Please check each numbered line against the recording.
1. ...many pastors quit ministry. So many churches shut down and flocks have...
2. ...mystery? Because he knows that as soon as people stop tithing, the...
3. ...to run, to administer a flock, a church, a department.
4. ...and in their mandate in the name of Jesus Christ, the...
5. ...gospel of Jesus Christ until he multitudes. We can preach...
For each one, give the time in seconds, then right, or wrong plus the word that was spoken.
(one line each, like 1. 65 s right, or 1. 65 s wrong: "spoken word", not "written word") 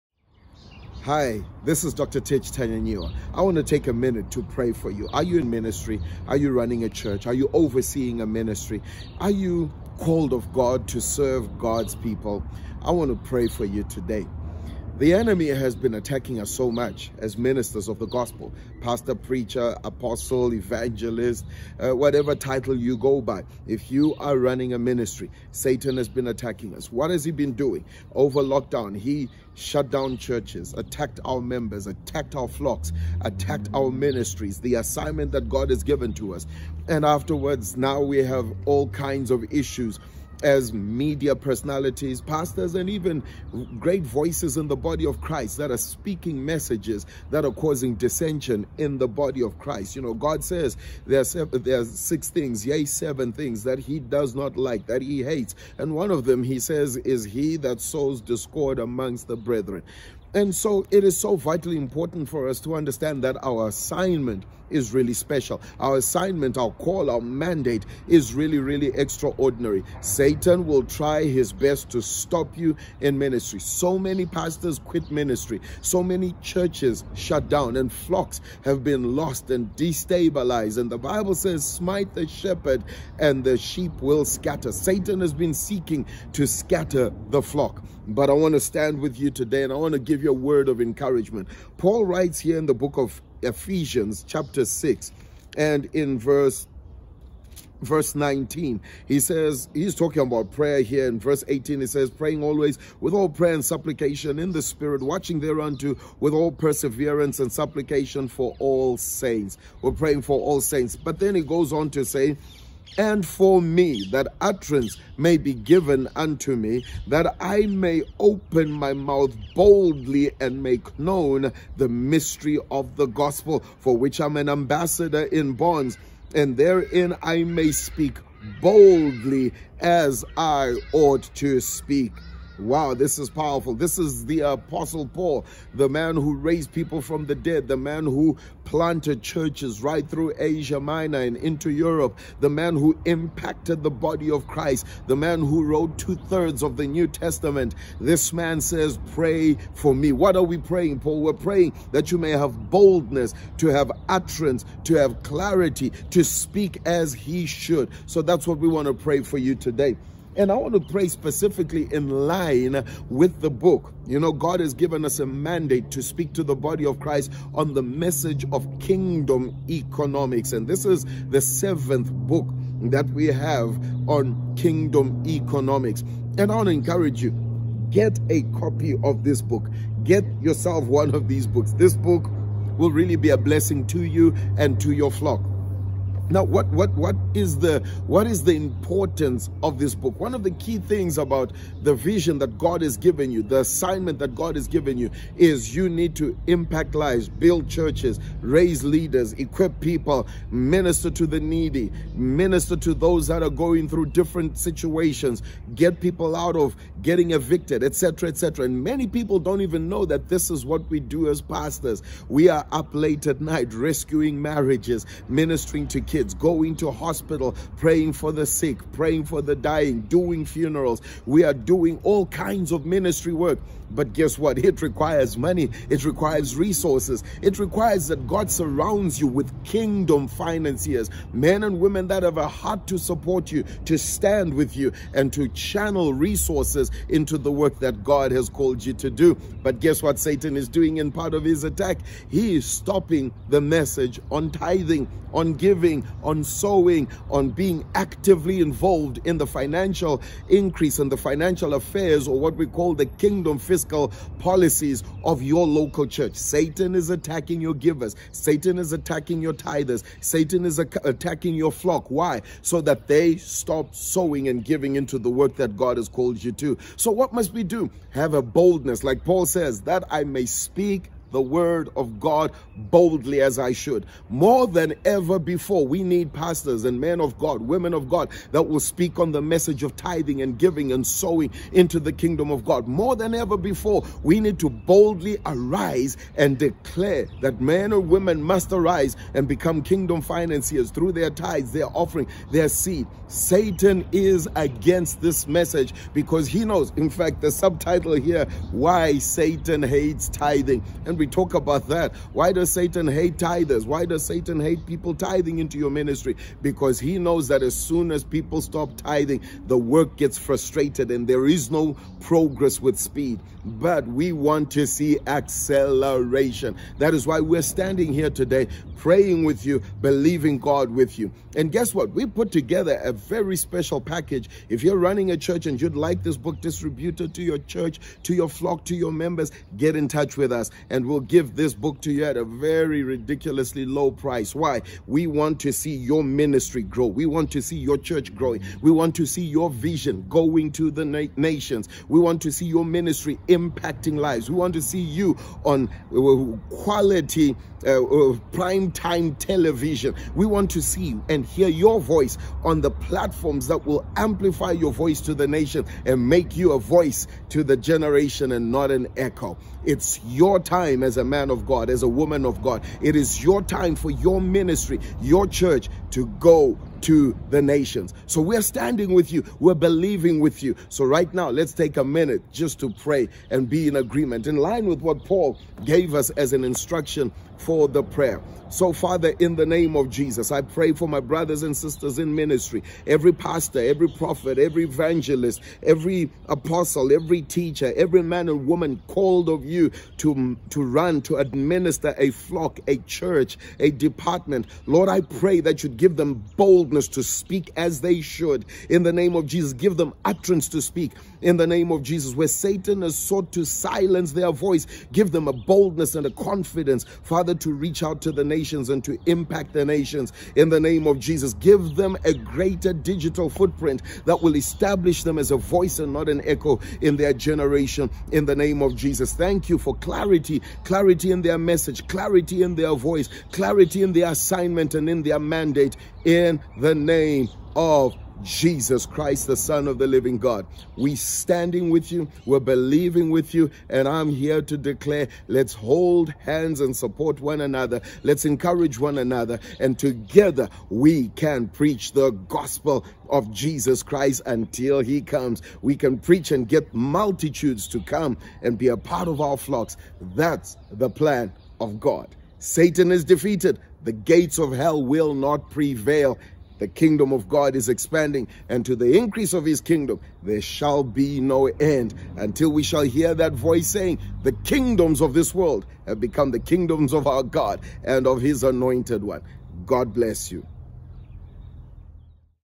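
1. 73 s right
2. 305 s wrong: "ministry", not "mystery"
3. 390 s right
4. 424 s right
5. 442 s wrong: "comes", not "multitudes".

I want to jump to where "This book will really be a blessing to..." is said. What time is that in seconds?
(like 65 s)
181 s.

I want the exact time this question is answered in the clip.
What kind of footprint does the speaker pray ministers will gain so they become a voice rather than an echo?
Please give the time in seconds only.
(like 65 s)
412 s.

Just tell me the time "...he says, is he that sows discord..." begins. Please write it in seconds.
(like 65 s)
56 s.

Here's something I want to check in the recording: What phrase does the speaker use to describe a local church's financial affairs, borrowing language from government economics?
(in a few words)
kingdom fiscal policies.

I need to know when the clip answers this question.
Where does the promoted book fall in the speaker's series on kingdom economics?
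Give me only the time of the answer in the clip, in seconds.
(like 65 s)
171 s.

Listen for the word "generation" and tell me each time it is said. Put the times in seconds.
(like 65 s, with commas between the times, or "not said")
357 s, 417 s.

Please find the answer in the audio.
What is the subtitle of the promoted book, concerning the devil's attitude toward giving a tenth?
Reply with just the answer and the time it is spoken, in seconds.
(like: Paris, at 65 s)
Why Satan Hates Tithing, at 298 s.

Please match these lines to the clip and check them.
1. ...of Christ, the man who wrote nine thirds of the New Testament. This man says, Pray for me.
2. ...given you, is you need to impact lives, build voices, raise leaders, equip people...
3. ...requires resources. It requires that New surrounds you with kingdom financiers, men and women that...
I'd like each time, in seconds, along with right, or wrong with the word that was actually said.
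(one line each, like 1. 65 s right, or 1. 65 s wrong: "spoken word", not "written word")
1. 144 s wrong: "two", not "nine"
2. 194 s wrong: "churches", not "voices"
3. 226 s wrong: "God", not "New".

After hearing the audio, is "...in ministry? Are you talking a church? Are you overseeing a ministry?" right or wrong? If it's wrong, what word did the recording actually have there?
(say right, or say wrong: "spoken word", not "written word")
wrong: "running", not "talking".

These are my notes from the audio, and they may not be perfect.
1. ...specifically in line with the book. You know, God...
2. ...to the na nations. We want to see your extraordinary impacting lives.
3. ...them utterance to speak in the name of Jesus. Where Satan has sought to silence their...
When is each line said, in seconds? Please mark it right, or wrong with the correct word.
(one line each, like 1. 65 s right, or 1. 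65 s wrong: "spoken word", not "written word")
1. 161 s right
2. 340 s wrong: "ministry", not "extraordinary"
3. 399 s right.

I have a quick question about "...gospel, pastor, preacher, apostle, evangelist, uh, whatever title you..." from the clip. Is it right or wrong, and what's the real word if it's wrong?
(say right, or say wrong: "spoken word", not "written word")
right.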